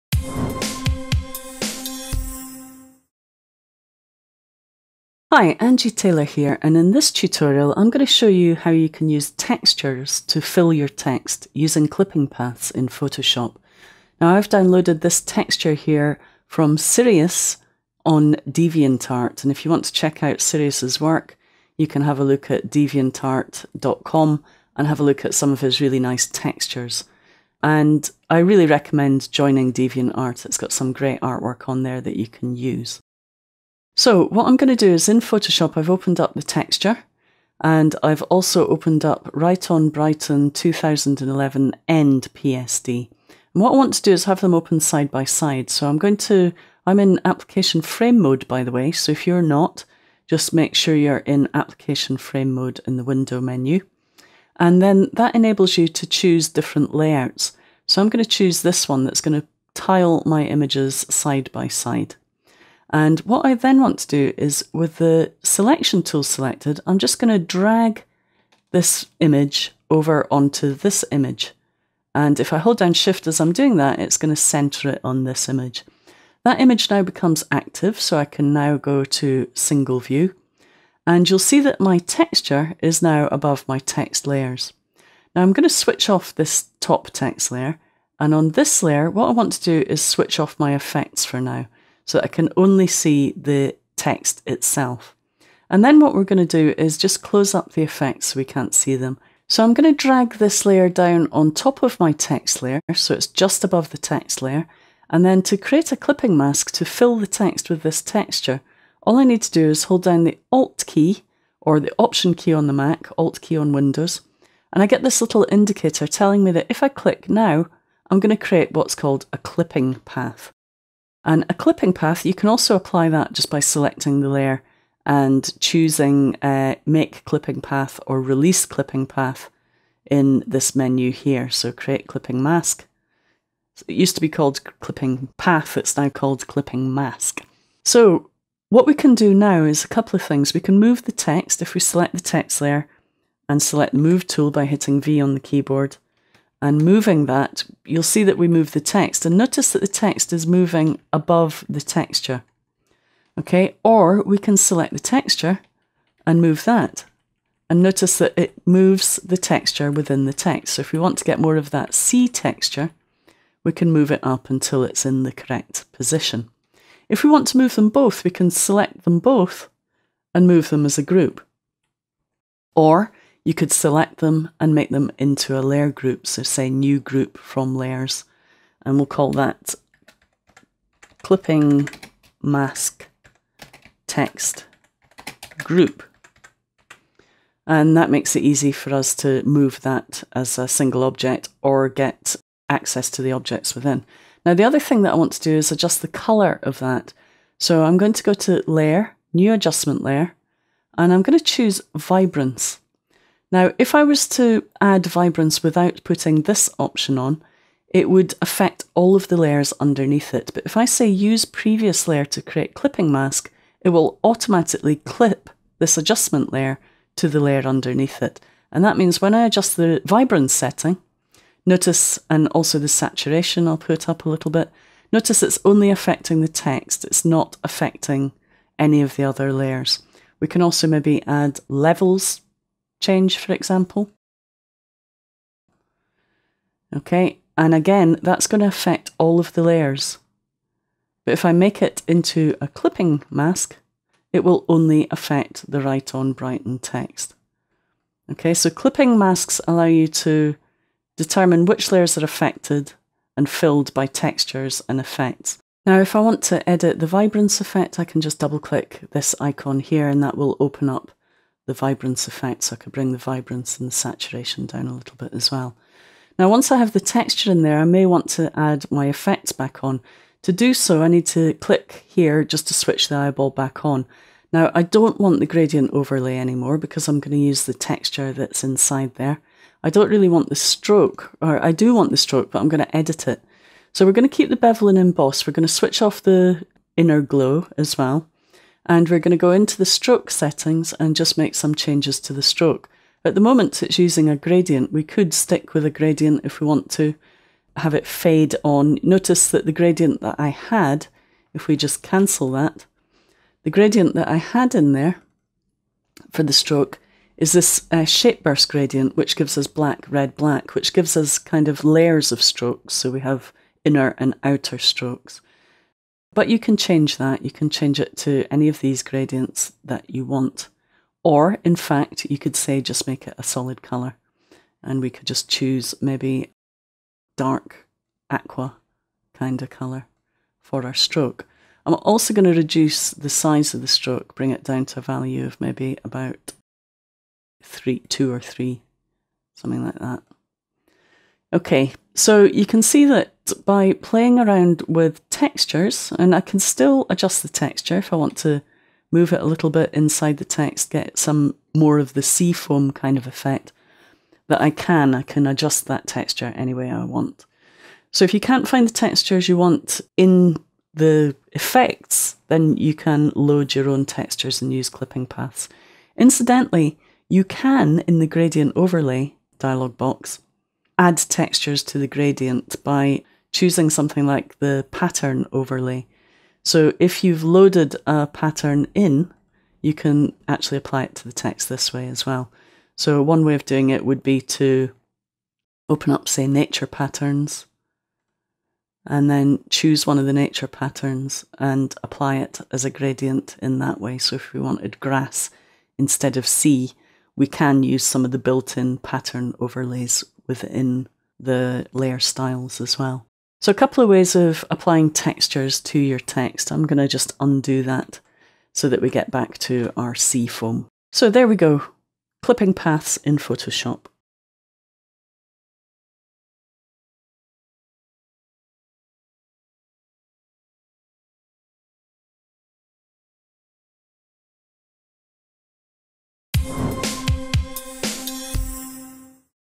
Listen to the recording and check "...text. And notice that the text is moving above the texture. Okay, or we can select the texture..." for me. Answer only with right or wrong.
right.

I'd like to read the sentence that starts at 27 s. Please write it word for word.
And I really recommend joining DeviantArt.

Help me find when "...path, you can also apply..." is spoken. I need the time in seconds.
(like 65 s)
121 s.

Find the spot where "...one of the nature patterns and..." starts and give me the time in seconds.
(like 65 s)
390 s.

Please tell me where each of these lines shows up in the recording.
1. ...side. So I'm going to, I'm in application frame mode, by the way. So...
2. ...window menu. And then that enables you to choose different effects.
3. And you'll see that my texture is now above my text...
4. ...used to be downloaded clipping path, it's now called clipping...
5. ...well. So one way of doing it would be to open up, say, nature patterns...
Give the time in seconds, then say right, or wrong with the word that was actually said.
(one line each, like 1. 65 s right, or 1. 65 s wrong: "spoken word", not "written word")
1. 45 s right
2. 53 s wrong: "layouts", not "effects"
3. 81 s right
4. 133 s wrong: "called", not "downloaded"
5. 382 s right.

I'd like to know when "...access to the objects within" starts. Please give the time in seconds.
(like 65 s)
192 s.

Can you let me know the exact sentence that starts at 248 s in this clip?
Okay, so clipping masks allow you to determine which layers are affected and filled by textures and effects.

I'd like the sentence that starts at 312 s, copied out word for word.
So we have inner and outer strokes.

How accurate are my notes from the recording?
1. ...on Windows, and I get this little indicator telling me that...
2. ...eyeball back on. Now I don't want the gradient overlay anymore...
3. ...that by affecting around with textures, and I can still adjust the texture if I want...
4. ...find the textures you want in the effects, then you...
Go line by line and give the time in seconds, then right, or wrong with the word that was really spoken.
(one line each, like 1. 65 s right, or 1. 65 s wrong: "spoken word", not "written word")
1. 113 s right
2. 273 s right
3. 343 s wrong: "playing", not "affecting"
4. 358 s right.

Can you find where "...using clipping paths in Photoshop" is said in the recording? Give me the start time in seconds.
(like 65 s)
11 s.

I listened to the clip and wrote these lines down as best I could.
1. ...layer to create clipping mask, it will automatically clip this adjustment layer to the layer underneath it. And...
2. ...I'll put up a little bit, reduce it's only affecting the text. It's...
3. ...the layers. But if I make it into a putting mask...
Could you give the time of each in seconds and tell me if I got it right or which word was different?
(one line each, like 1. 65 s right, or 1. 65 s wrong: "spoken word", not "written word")
1. 212 s right
2. 223 s wrong: "notice", not "reduce"
3. 239 s wrong: "clipping", not "putting".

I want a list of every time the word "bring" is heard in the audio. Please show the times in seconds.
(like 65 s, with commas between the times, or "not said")
262 s, 334 s.